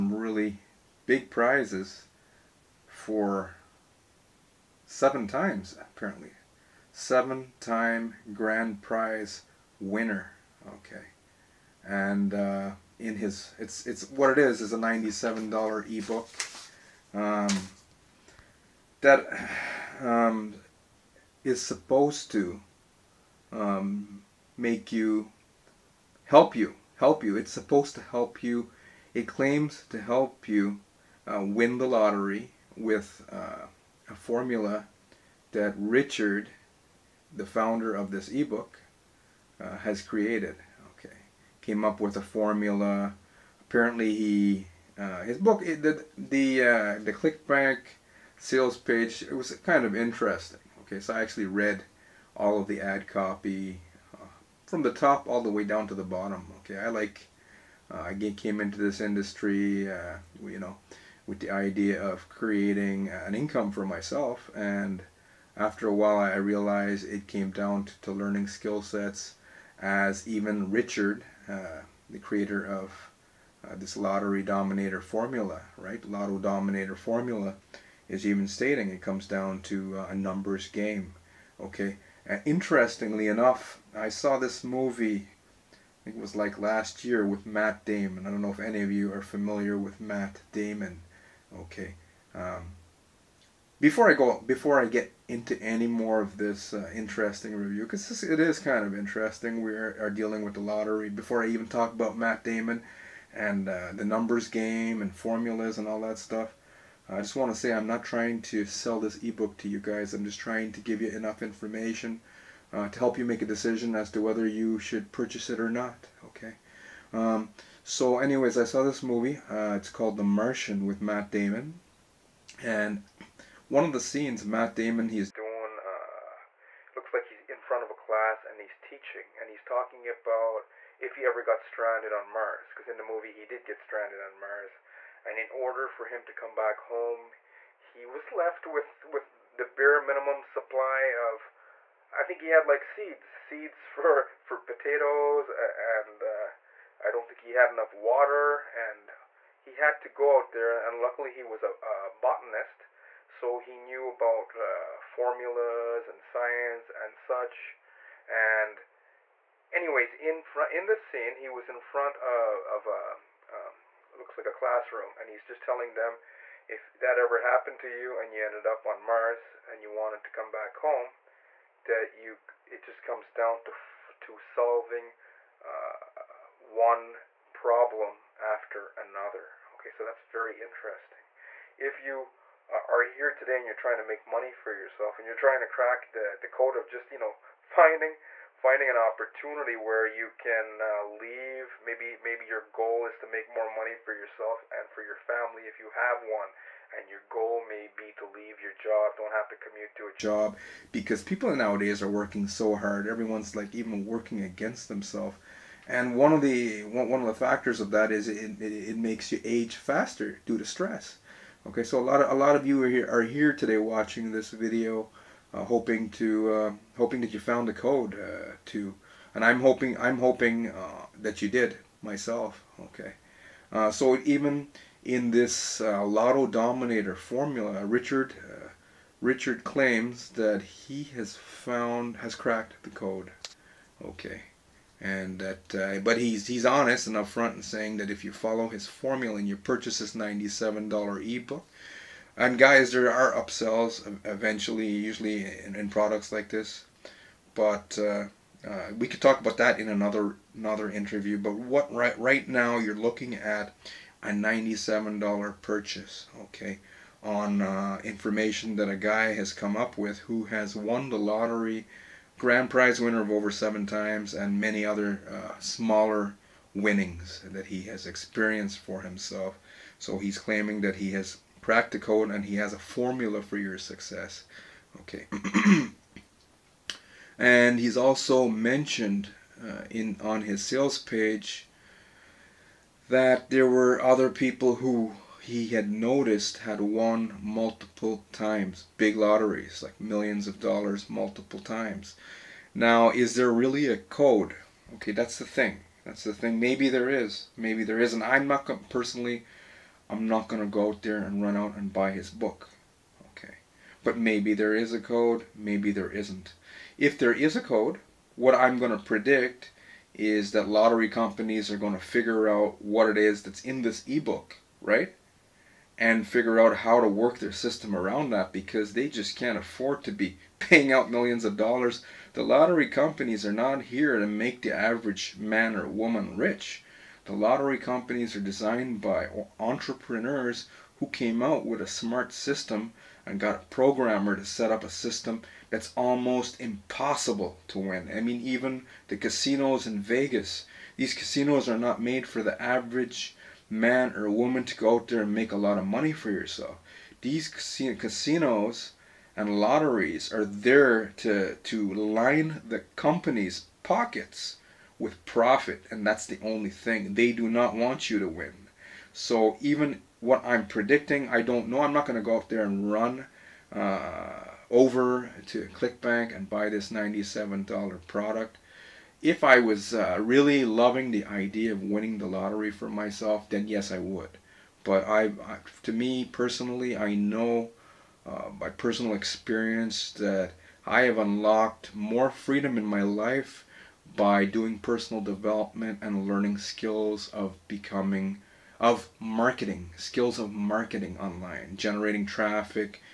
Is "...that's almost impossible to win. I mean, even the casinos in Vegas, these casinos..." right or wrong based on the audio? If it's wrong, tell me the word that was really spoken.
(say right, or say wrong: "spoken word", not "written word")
right.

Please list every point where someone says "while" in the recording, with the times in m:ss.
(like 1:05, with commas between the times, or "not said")
1:05.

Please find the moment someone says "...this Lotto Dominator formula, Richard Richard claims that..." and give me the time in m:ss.
3:45.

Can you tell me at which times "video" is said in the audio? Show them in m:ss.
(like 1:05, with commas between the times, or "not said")
3:34.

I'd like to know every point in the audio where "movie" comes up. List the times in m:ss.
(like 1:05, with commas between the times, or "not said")
1:24, 1:59, 2:13.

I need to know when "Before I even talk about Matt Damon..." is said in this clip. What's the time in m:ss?
1:41.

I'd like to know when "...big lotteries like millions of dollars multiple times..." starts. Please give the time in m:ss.
4:48.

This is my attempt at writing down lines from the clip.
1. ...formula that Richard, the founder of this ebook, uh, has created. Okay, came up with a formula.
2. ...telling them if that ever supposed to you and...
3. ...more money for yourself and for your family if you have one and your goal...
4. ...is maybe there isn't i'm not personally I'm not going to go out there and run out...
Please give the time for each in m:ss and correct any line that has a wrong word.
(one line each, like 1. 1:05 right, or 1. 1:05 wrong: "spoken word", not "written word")
1. 0:34 right
2. 2:45 wrong: "happened", not "supposed"
3. 3:13 right
4. 4:57 right.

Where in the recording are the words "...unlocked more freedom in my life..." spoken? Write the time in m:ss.
6:21.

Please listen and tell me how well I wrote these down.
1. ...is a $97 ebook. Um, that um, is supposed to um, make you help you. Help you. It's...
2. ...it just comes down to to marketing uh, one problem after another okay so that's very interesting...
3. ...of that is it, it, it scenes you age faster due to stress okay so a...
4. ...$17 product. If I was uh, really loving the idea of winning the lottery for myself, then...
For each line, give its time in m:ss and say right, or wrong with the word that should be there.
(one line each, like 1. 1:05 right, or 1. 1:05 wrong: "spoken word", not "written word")
1. 0:14 right
2. 2:52 wrong: "solving", not "marketing"
3. 3:27 wrong: "makes", not "scenes"
4. 6:06 wrong: "97", not "17".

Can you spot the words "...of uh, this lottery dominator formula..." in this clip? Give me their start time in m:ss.
1:12.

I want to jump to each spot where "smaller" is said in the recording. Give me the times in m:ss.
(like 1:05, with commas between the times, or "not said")
4:25.